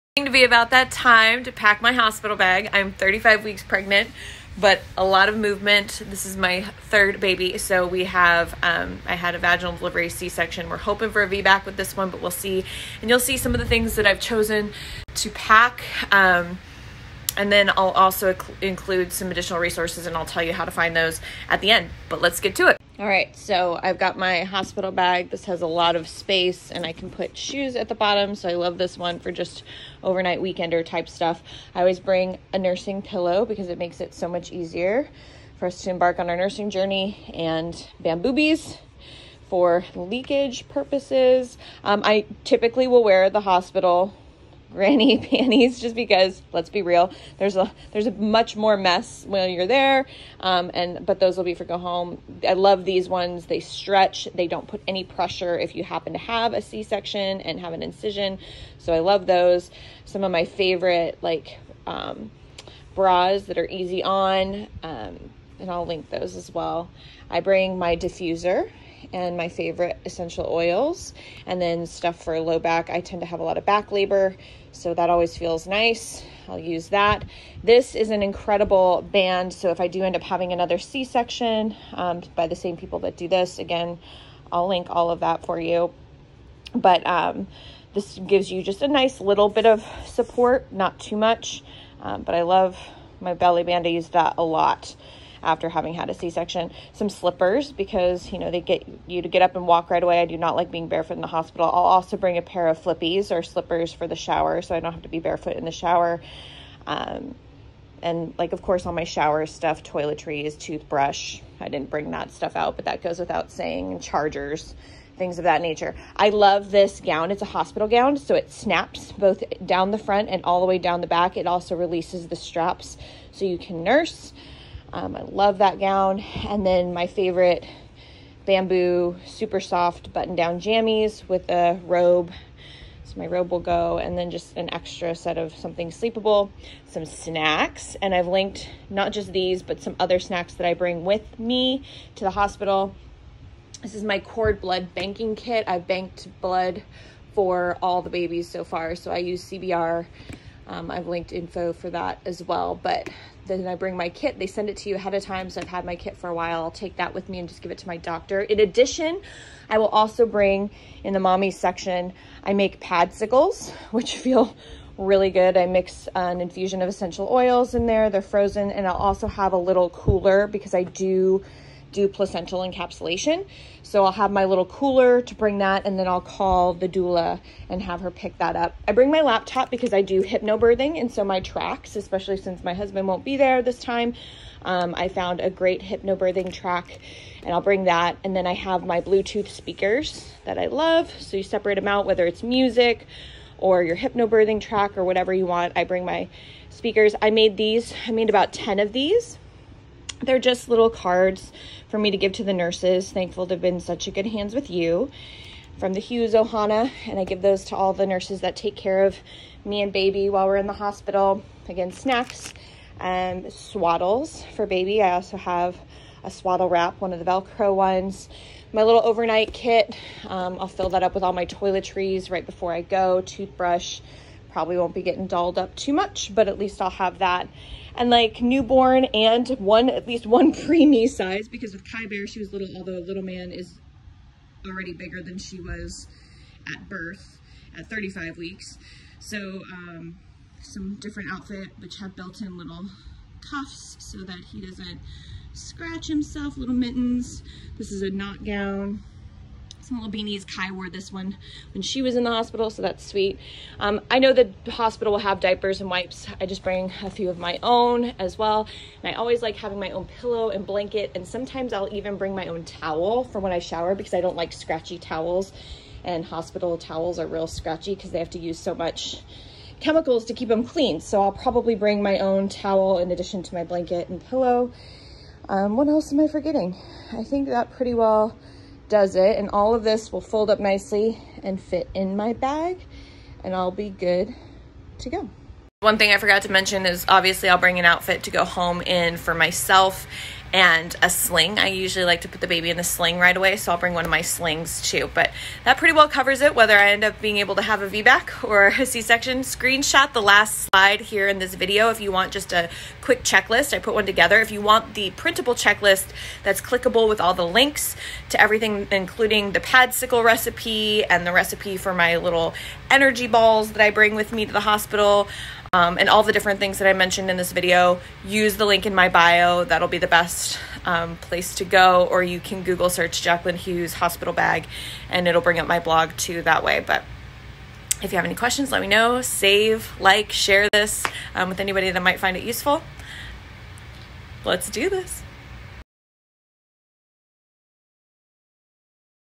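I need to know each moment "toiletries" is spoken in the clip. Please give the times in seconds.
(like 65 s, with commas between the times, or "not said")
109 s, 221 s.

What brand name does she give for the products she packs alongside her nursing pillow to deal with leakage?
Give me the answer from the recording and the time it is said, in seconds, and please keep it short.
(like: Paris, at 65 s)
Bamboobies, at 38 s.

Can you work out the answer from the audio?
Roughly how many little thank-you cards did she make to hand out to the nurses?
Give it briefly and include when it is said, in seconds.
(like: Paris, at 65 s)
10, at 198 s.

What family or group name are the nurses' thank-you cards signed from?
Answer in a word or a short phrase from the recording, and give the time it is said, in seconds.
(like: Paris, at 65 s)
Hughes Ohana, at 205 s.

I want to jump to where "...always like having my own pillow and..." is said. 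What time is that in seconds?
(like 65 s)
259 s.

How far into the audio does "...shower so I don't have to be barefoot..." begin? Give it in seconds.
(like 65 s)
104 s.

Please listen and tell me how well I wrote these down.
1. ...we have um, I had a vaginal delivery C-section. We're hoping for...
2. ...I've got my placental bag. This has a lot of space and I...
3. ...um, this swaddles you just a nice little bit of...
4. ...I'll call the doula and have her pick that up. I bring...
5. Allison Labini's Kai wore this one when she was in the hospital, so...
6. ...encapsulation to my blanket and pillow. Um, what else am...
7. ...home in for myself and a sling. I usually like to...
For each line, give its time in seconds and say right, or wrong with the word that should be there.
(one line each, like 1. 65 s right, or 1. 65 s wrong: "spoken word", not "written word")
1. 7 s right
2. 23 s wrong: "hospital", not "placental"
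3. 87 s wrong: "gives", not "swaddles"
4. 176 s right
5. 249 s right
6. 273 s wrong: "addition", not "encapsulation"
7. 288 s right.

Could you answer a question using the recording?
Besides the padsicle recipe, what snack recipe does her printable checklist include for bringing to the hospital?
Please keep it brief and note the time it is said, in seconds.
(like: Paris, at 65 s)
Energy balls, at 312 s.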